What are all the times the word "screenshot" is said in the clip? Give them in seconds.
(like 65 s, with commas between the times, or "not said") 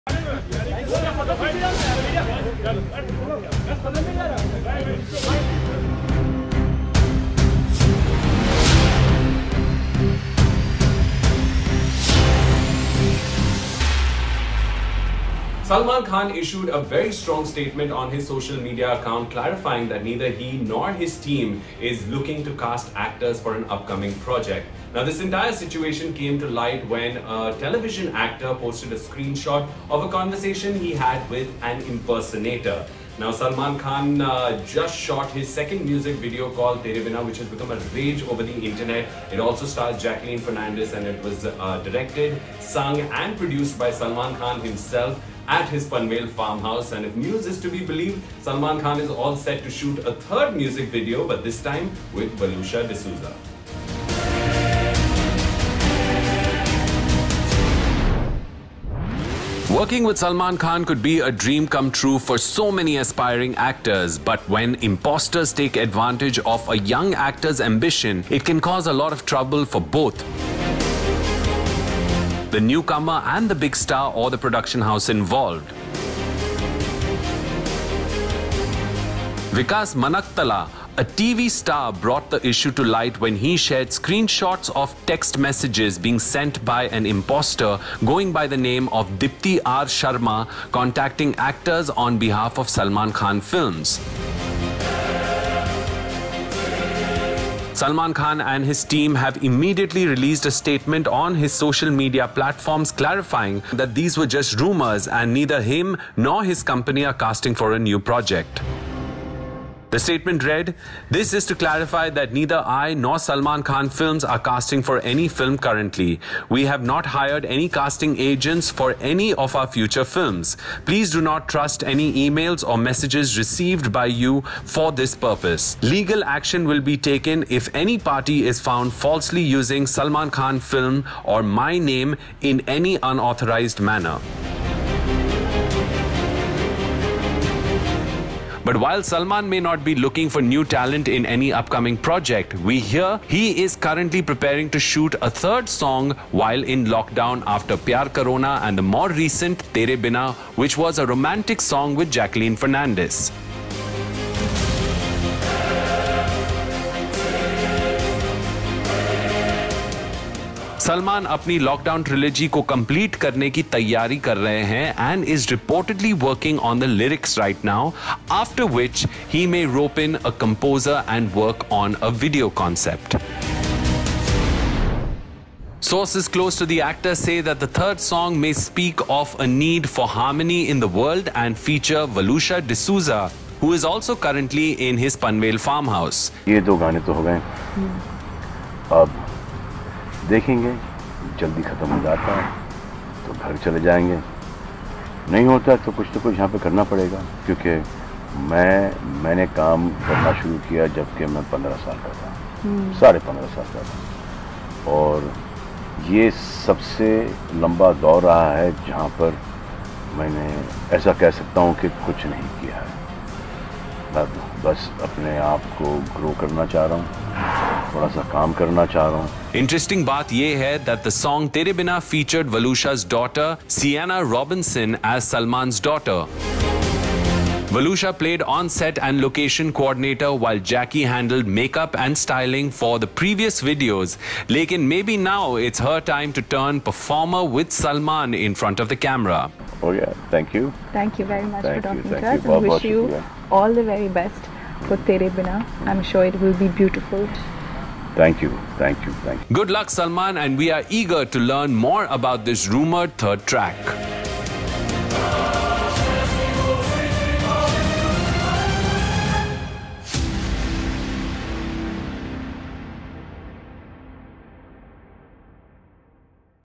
28 s, 83 s.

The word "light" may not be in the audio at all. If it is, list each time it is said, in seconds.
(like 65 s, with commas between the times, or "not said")
26 s, 82 s.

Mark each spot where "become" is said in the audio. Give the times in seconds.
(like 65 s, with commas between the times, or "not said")
37 s.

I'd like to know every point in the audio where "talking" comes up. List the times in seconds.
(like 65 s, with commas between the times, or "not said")
241 s.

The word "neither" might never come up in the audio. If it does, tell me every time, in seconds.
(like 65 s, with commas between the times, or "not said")
20 s, 105 s, 112 s.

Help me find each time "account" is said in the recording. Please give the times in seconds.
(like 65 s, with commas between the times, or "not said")
18 s.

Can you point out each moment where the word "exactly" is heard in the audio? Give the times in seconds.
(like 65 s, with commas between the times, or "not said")
not said.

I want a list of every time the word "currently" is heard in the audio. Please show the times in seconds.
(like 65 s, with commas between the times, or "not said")
115 s, 143 s, 184 s.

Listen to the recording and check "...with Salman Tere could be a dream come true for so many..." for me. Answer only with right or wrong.
wrong.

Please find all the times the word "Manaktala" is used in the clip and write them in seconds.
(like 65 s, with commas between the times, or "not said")
79 s.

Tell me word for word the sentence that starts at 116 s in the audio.
We have not hired any casting agents for any of our future films.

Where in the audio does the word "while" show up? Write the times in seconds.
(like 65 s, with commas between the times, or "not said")
138 s, 146 s, 230 s.